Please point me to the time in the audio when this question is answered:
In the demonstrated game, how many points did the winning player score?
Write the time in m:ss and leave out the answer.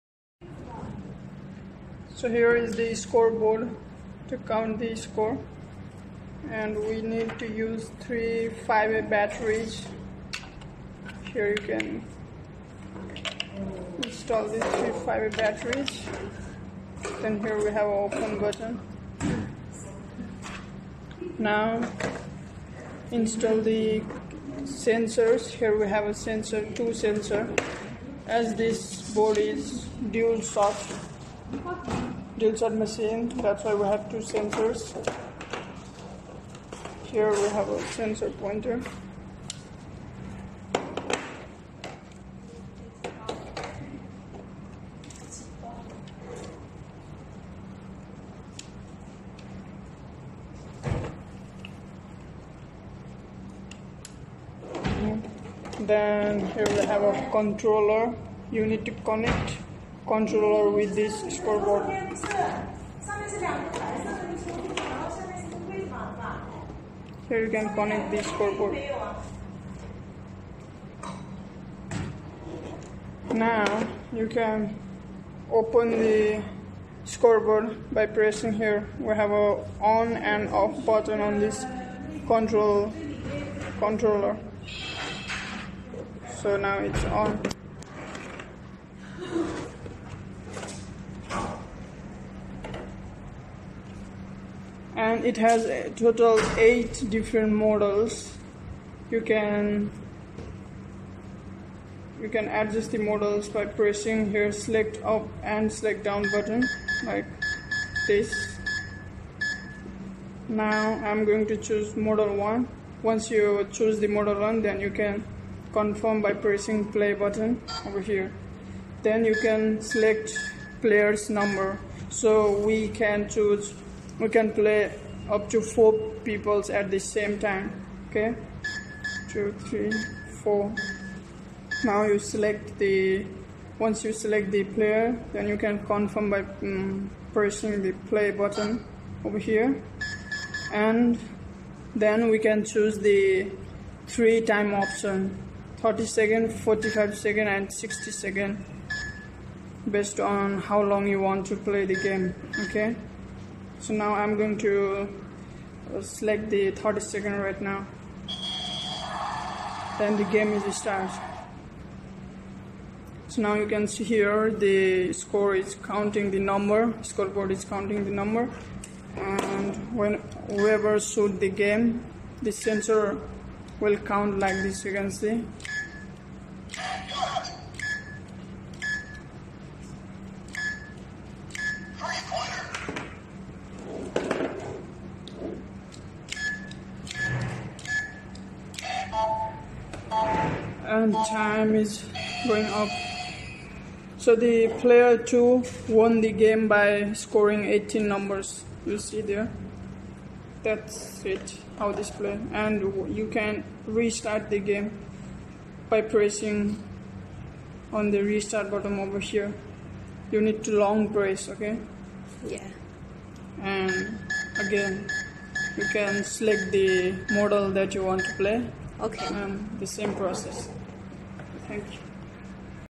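3:17.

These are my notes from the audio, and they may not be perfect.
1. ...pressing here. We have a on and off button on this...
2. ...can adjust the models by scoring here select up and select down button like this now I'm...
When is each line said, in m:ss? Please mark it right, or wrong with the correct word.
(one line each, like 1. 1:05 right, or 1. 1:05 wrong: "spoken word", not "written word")
1. 1:18 right
2. 1:42 wrong: "pressing", not "scoring".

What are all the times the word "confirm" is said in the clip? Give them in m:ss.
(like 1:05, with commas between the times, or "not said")
1:55, 2:15.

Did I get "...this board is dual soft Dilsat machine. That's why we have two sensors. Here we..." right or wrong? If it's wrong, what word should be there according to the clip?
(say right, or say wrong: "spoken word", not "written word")
right.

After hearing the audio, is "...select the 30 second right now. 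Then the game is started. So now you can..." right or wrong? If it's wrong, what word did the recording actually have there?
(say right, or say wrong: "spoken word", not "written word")
right.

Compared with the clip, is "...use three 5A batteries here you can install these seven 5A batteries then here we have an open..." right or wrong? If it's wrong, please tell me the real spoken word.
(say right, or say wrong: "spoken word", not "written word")
wrong: "three", not "seven".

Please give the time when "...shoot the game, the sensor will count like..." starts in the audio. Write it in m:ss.
2:50.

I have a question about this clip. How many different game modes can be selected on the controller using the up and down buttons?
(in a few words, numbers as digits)
8.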